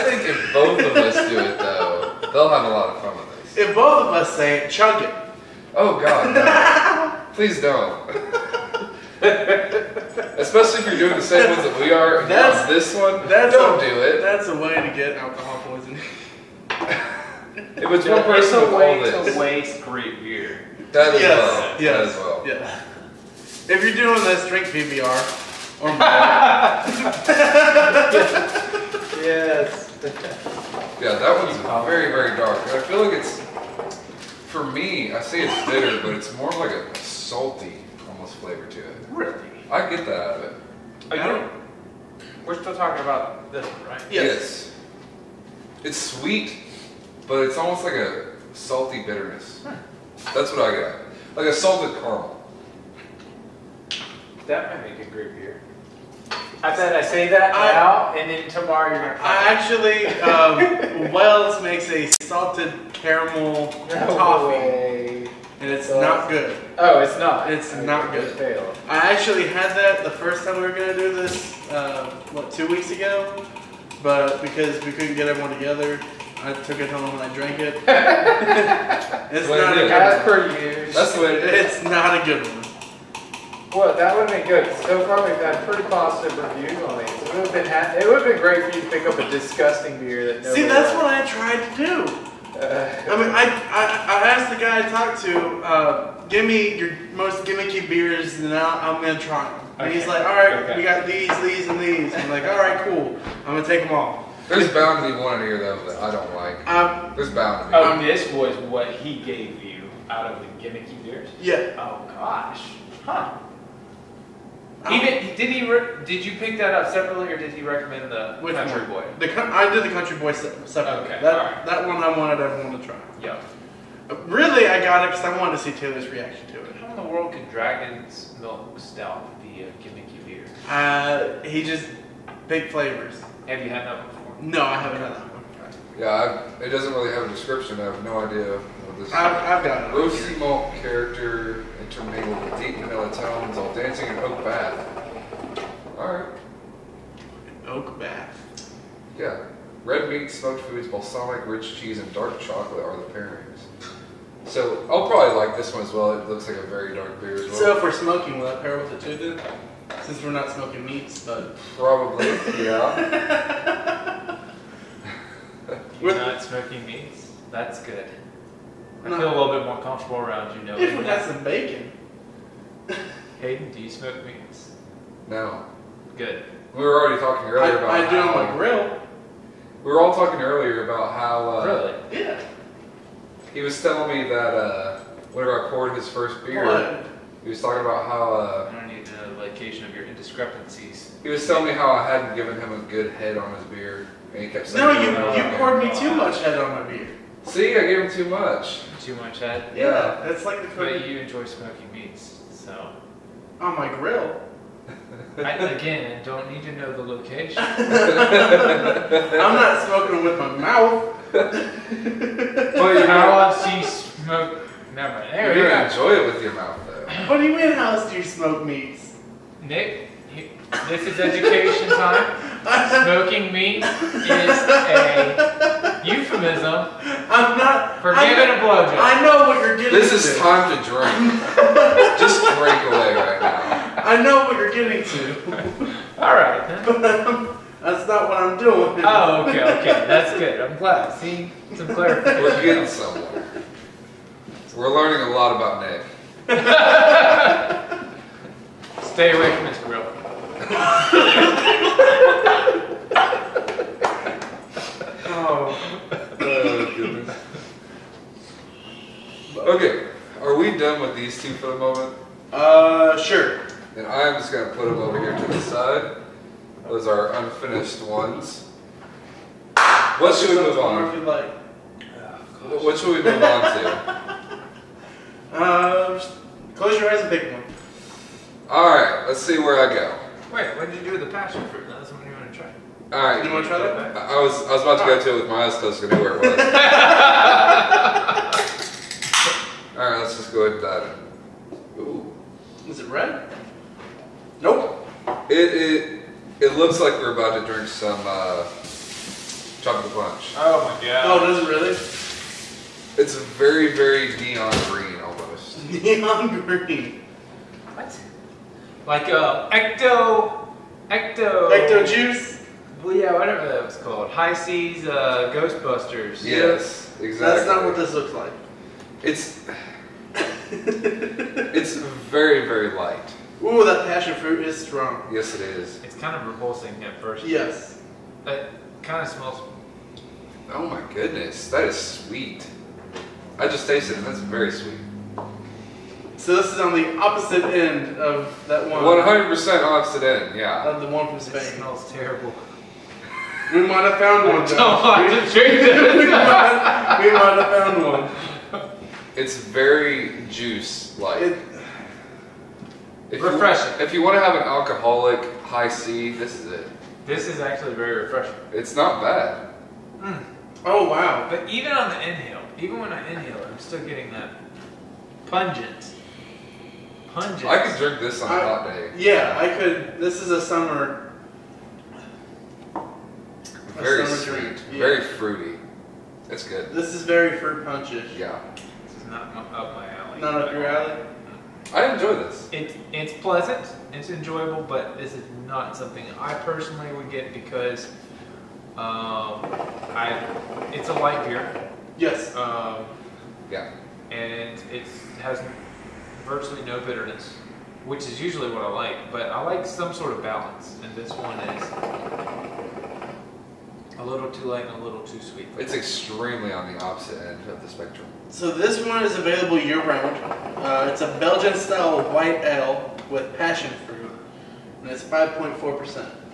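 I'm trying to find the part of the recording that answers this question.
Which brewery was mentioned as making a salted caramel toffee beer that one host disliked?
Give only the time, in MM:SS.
01:01.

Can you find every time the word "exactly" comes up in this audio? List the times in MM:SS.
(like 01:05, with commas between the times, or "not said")
05:17.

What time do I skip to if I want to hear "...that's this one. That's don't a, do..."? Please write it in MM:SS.
00:12.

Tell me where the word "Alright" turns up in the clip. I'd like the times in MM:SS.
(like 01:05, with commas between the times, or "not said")
02:25, 04:43, 04:49.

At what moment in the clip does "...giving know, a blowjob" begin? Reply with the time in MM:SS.
03:48.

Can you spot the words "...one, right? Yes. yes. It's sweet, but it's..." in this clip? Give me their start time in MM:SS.
00:43.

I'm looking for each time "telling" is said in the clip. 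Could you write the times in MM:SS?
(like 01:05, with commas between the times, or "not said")
03:03, 03:11.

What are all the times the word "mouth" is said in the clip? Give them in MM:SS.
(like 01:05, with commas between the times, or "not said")
03:30, 03:36.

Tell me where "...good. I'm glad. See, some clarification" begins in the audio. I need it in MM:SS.
04:00.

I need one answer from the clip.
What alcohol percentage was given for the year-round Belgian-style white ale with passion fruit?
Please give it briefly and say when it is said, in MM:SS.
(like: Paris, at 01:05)
5.4%, at 06:55.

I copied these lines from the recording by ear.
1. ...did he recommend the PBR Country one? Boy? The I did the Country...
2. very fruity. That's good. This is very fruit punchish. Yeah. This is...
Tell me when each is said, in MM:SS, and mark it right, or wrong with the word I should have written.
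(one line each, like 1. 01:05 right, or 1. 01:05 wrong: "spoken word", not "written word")
1. 01:57 wrong: "Which", not "PBR"
2. 06:14 right.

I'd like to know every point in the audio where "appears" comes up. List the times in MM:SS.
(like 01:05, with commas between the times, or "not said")
not said.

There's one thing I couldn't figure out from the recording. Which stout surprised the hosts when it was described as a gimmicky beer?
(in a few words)
Dragon's Milk.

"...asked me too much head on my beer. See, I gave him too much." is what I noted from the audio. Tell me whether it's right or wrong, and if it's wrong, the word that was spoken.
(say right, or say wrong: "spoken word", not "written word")
wrong: "poured", not "asked".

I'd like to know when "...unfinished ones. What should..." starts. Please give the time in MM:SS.
04:27.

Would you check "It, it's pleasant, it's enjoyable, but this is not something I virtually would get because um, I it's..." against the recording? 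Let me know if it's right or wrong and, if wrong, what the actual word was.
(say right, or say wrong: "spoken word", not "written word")
wrong: "personally", not "virtually".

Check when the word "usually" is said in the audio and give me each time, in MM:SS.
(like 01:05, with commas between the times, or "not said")
06:38.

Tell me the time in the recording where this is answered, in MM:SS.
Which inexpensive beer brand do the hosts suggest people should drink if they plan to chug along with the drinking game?
00:24.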